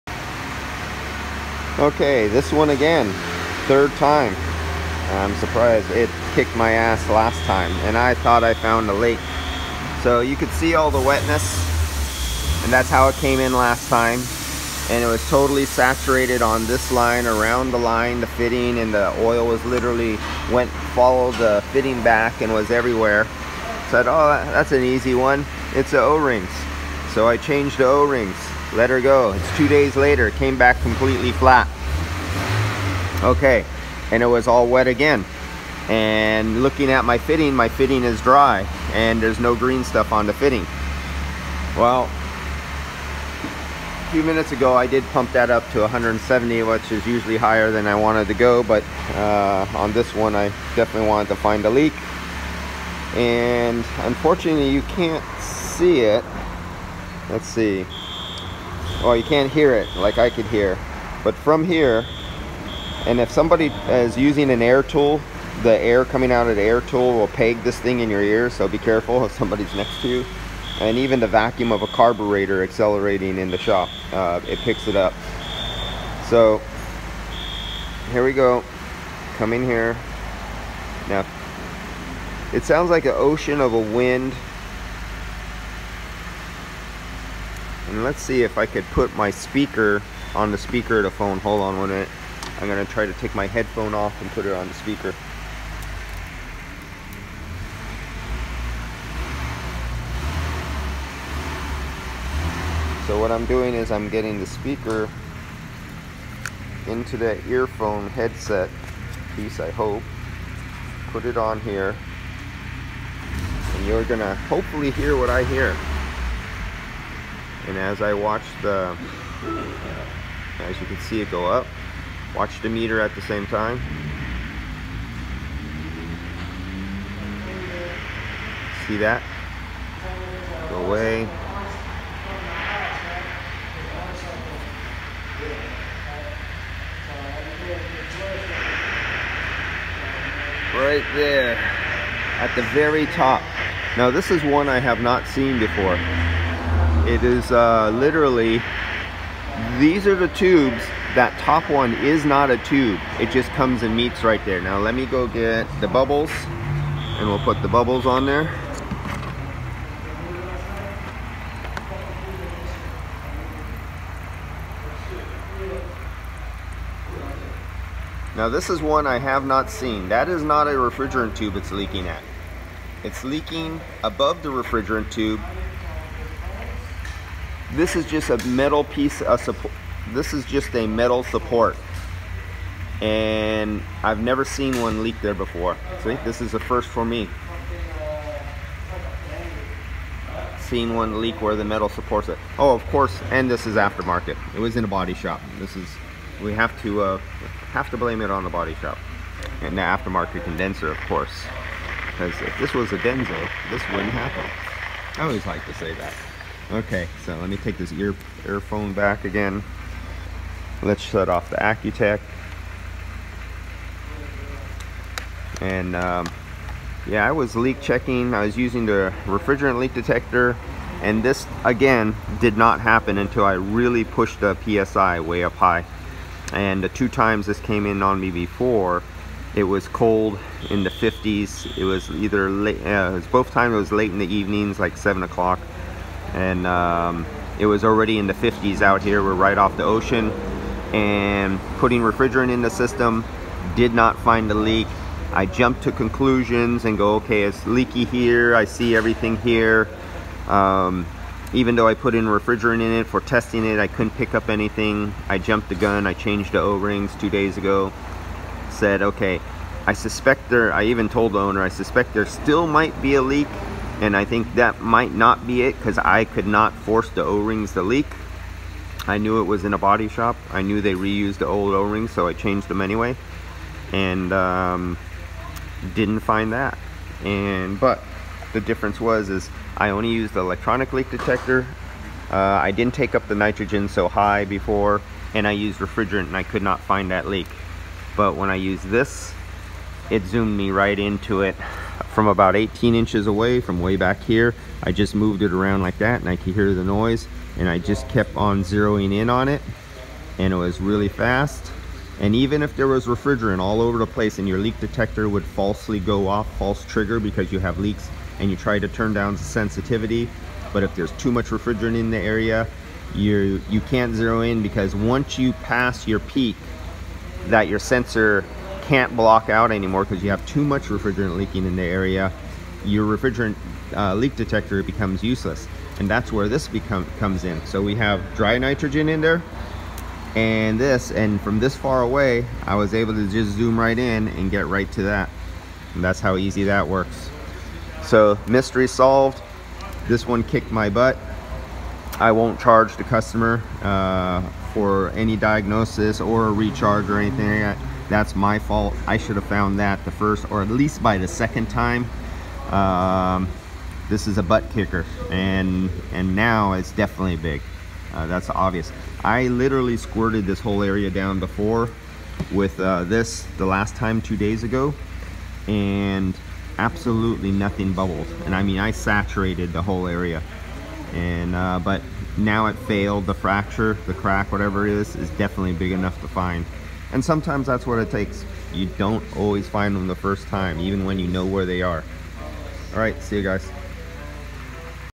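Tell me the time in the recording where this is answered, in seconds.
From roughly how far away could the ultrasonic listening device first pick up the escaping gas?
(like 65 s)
292 s.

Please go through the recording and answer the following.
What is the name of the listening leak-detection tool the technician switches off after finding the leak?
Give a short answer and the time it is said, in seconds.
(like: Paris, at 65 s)
AccuTrack, at 211 s.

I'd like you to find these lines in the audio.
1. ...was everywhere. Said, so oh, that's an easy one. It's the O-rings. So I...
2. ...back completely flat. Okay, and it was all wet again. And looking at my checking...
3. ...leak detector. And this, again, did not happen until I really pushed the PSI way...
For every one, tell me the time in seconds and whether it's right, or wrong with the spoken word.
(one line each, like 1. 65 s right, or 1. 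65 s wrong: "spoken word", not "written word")
1. 22 s right
2. 30 s wrong: "fitting", not "checking"
3. 219 s right.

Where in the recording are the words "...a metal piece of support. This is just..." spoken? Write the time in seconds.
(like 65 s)
178 s.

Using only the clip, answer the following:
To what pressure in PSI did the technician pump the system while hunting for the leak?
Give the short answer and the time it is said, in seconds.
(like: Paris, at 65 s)
170, at 45 s.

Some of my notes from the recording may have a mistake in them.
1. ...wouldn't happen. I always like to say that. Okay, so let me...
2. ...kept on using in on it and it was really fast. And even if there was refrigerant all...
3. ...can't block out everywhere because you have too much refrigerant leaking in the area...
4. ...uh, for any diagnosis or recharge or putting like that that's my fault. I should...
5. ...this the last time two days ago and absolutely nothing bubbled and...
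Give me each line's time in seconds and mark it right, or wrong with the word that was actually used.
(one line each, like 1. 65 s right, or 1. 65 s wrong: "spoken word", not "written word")
1. 203 s right
2. 298 s wrong: "zeroing", not "using"
3. 318 s wrong: "anymore", not "everywhere"
4. 343 s wrong: "anything", not "putting"
5. 363 s right.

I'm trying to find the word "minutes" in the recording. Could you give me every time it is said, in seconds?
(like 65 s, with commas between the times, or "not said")
44 s, 91 s.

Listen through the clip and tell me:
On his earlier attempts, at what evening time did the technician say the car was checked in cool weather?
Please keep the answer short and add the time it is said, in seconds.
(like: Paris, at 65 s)
7 o'clock, at 234 s.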